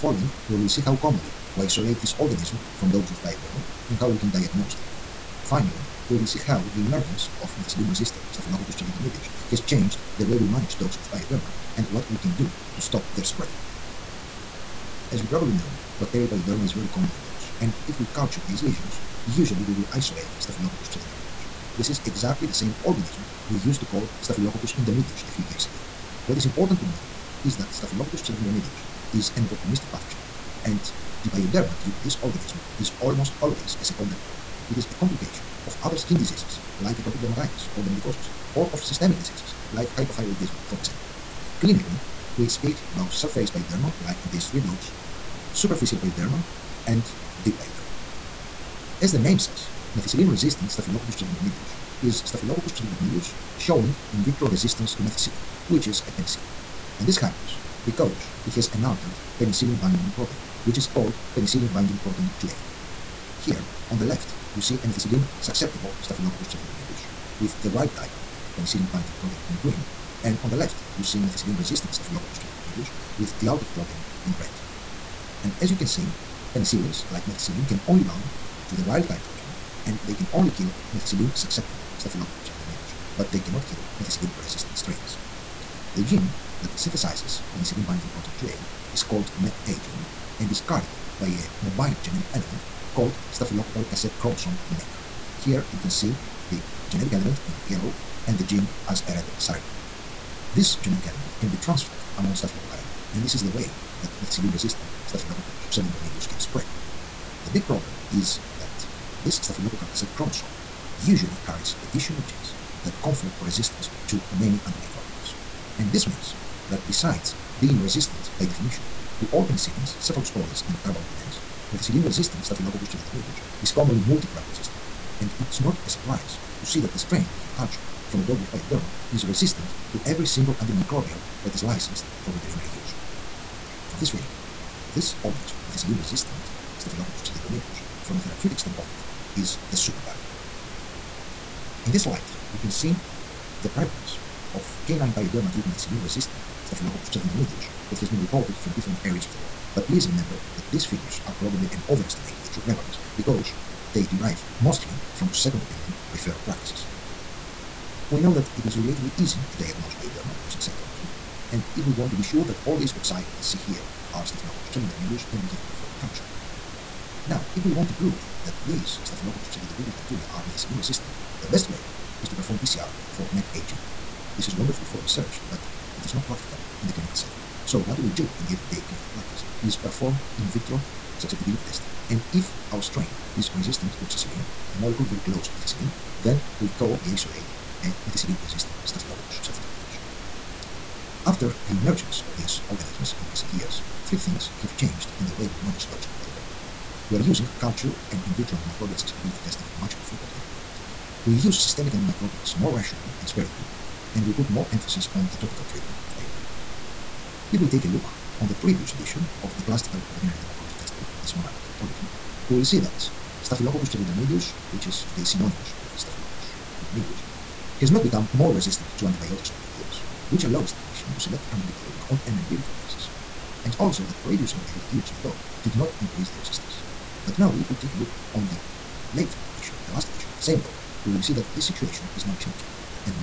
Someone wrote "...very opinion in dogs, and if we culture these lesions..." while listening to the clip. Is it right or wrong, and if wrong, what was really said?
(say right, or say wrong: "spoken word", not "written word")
wrong: "common", not "opinion".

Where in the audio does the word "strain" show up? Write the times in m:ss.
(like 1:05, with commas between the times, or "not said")
1:24, 2:06, 3:02.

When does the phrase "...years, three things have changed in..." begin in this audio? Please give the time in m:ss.
3:13.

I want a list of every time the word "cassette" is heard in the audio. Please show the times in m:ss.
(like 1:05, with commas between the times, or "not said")
1:33, 1:49.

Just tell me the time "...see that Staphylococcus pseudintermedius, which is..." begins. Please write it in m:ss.
3:32.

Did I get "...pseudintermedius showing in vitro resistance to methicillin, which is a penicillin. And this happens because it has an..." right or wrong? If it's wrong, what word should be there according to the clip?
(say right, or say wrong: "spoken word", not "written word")
right.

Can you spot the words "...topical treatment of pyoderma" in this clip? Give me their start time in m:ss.
3:25.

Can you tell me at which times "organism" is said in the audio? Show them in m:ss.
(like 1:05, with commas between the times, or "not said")
0:02, 0:22, 0:32, 2:15, 3:12.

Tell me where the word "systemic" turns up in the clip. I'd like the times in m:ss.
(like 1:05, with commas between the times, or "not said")
0:38, 3:21.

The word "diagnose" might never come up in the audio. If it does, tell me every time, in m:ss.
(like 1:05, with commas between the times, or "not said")
0:04, 2:39.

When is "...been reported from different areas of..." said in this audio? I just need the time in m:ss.
2:28.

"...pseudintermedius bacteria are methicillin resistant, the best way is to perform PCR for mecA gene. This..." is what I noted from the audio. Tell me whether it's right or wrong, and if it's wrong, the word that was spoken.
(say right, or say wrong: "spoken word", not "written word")
right.